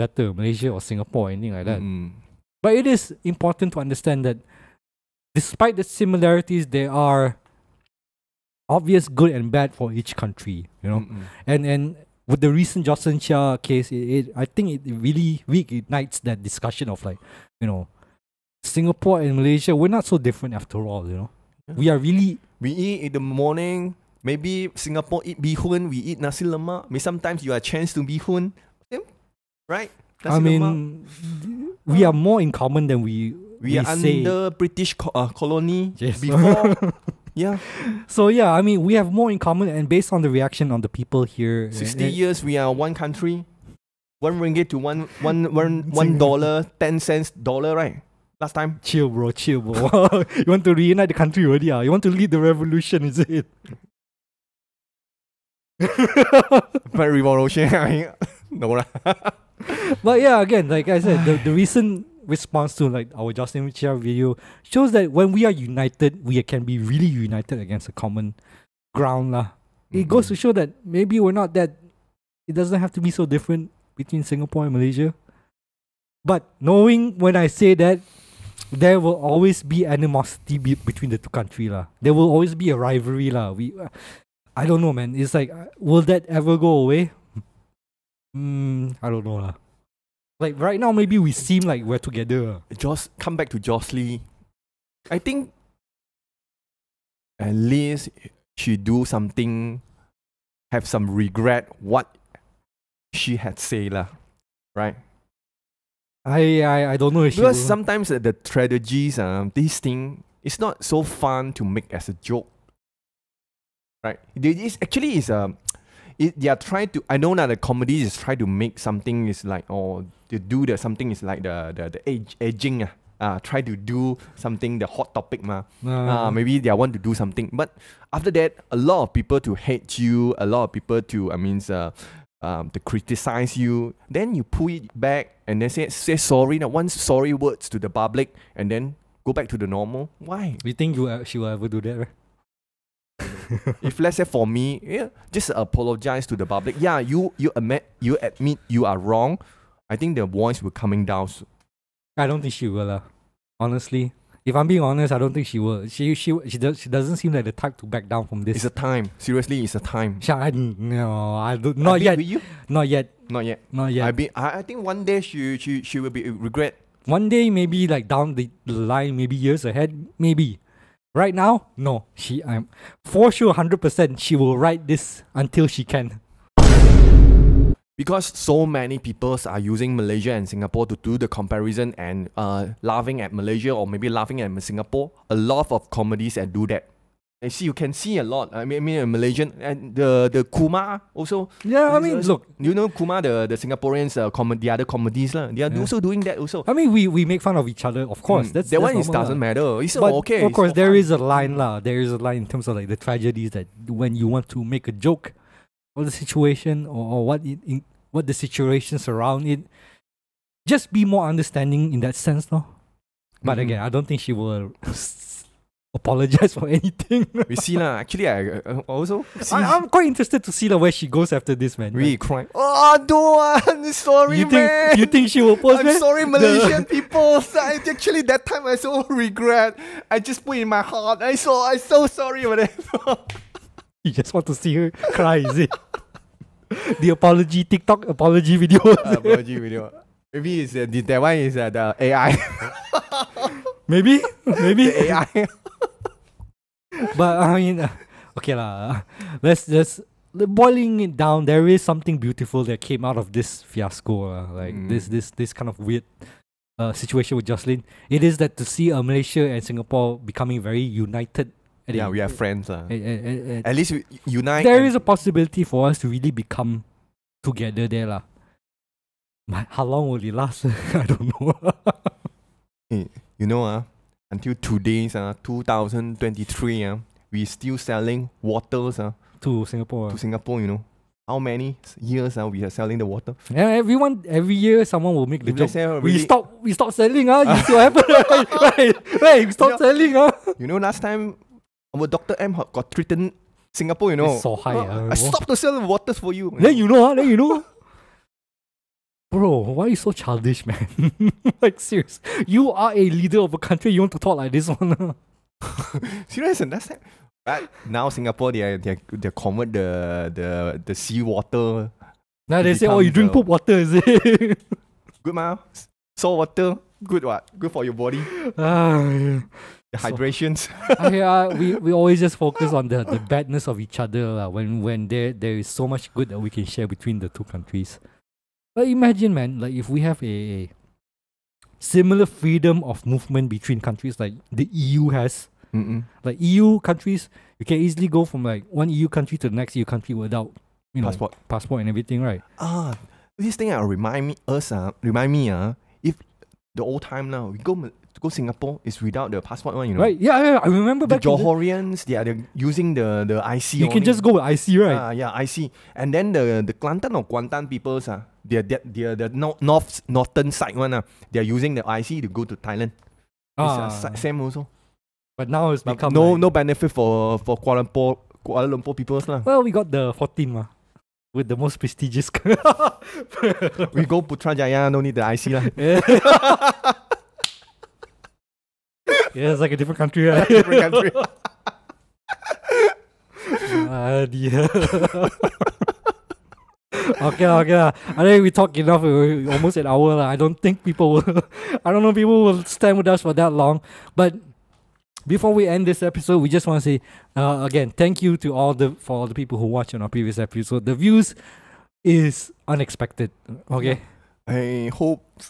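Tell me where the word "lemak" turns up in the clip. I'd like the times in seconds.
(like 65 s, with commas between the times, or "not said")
26 s, 30 s.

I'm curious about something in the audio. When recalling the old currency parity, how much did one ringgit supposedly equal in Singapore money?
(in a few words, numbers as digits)
one dollar ten cents.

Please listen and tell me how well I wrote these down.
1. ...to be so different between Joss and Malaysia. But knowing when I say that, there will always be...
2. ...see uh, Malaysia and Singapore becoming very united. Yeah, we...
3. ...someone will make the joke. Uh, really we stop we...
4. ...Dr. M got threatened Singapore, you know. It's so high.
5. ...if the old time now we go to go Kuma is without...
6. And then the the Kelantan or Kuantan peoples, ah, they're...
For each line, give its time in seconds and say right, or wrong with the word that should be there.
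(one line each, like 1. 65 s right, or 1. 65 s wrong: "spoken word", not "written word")
1. 72 s wrong: "Singapore", not "Joss"
2. 258 s right
3. 284 s right
4. 292 s right
5. 346 s wrong: "Singapore", not "Kuma"
6. 355 s right.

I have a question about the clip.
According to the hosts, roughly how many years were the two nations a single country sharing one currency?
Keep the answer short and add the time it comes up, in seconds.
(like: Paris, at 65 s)
60, at 41 s.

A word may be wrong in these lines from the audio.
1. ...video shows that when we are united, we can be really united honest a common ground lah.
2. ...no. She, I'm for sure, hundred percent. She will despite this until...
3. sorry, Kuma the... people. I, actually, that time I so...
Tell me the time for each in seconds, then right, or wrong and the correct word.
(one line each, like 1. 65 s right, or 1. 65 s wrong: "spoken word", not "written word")
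1. 63 s wrong: "against", not "honest"
2. 171 s wrong: "write", not "despite"
3. 225 s wrong: "Malaysian", not "Kuma".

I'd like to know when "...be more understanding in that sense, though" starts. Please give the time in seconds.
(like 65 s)
210 s.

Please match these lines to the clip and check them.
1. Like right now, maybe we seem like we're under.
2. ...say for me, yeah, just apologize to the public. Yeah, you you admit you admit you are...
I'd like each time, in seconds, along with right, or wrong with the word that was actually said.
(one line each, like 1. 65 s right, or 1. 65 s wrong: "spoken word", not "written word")
1. 90 s wrong: "together", not "under"
2. 144 s right.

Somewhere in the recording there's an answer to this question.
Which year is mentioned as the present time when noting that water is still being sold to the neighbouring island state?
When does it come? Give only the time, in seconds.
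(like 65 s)
275 s.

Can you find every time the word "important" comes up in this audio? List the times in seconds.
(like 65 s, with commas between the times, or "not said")
3 s.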